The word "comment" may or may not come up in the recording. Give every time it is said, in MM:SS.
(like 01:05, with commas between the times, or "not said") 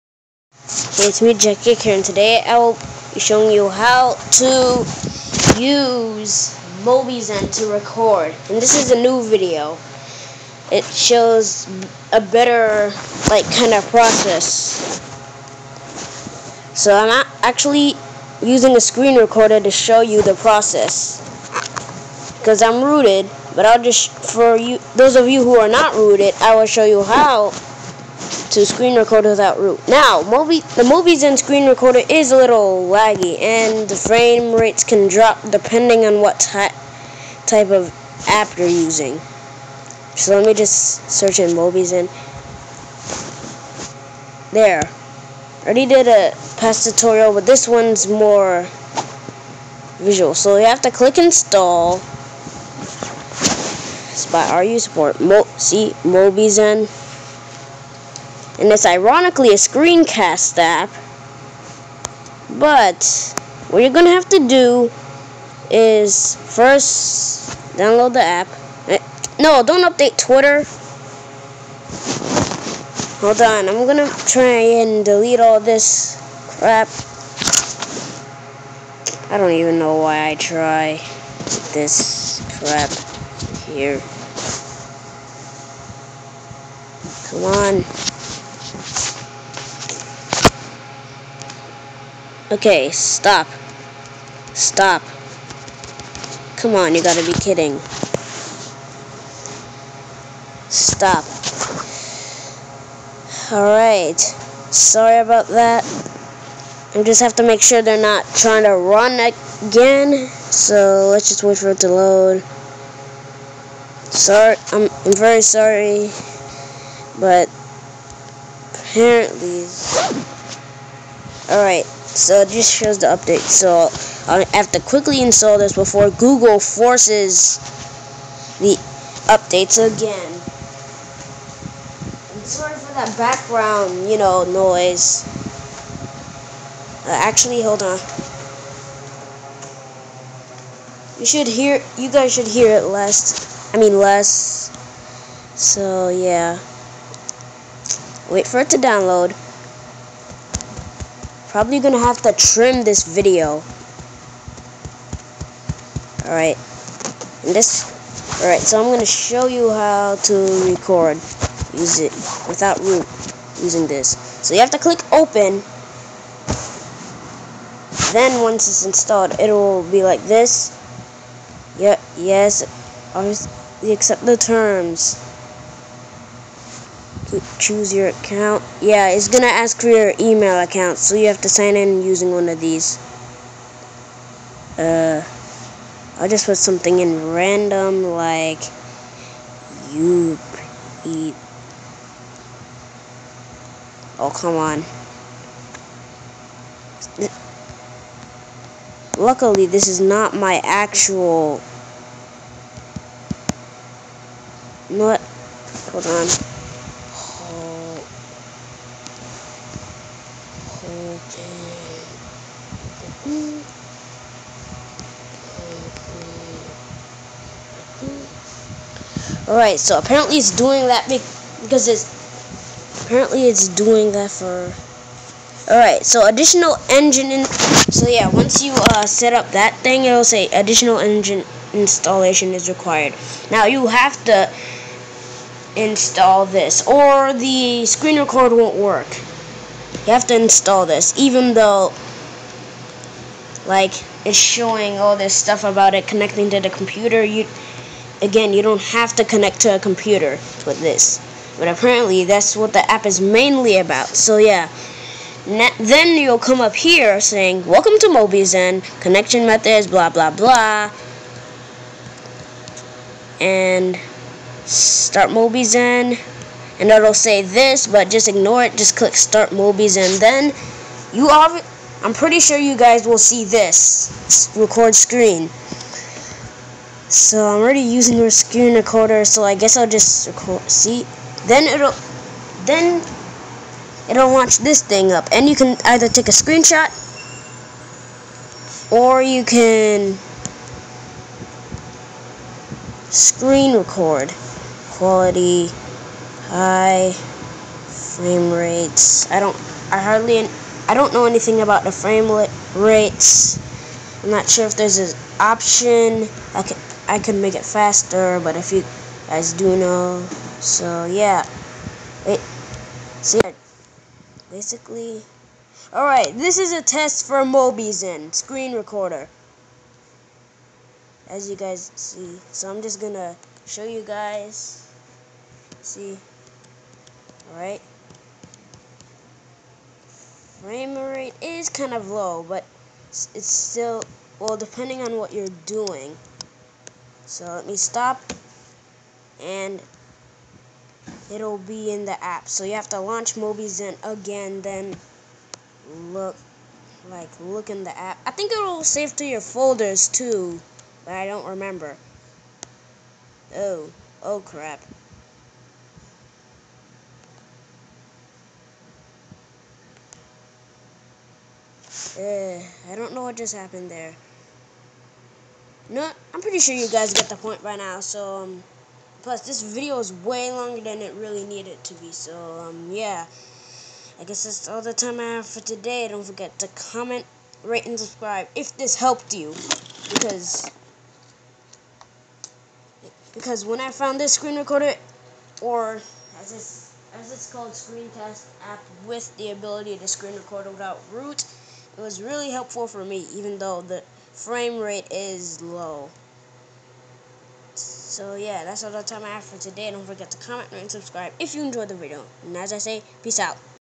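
06:16, 06:40.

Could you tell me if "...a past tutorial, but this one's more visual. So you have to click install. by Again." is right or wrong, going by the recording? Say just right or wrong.
wrong.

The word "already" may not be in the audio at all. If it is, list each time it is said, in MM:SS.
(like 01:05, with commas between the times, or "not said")
00:45, 04:37.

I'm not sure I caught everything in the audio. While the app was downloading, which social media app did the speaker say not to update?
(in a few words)
Twitter.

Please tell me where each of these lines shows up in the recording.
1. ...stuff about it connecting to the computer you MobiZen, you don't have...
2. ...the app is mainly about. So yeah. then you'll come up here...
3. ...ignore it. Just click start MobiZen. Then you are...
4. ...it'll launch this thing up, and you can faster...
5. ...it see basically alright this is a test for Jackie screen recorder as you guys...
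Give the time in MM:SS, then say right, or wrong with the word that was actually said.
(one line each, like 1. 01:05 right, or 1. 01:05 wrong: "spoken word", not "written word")
1. 04:05 wrong: "Again", not "MobiZen"
2. 04:12 right
3. 04:28 right
4. 04:44 wrong: "either", not "faster"
5. 05:12 wrong: "Mobizen", not "Jackie".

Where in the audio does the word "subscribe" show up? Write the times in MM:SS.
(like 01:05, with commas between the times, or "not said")
06:17, 06:40.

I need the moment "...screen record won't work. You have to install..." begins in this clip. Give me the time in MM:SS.
03:57.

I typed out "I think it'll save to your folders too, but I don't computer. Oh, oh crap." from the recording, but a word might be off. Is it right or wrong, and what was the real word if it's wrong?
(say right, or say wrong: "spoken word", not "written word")
wrong: "remember", not "computer".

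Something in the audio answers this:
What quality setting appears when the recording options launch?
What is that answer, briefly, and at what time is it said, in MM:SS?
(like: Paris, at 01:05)
High, at 04:56.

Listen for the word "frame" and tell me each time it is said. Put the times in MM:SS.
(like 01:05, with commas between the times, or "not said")
00:33, 04:57, 05:01, 05:30, 06:34.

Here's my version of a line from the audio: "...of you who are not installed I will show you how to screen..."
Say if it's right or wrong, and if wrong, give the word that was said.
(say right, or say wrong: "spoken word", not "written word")
wrong: "rooted", not "installed".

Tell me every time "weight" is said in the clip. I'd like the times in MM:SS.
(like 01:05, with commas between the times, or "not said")
not said.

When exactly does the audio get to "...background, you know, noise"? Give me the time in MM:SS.
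02:13.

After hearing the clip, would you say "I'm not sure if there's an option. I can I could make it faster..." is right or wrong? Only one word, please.
right.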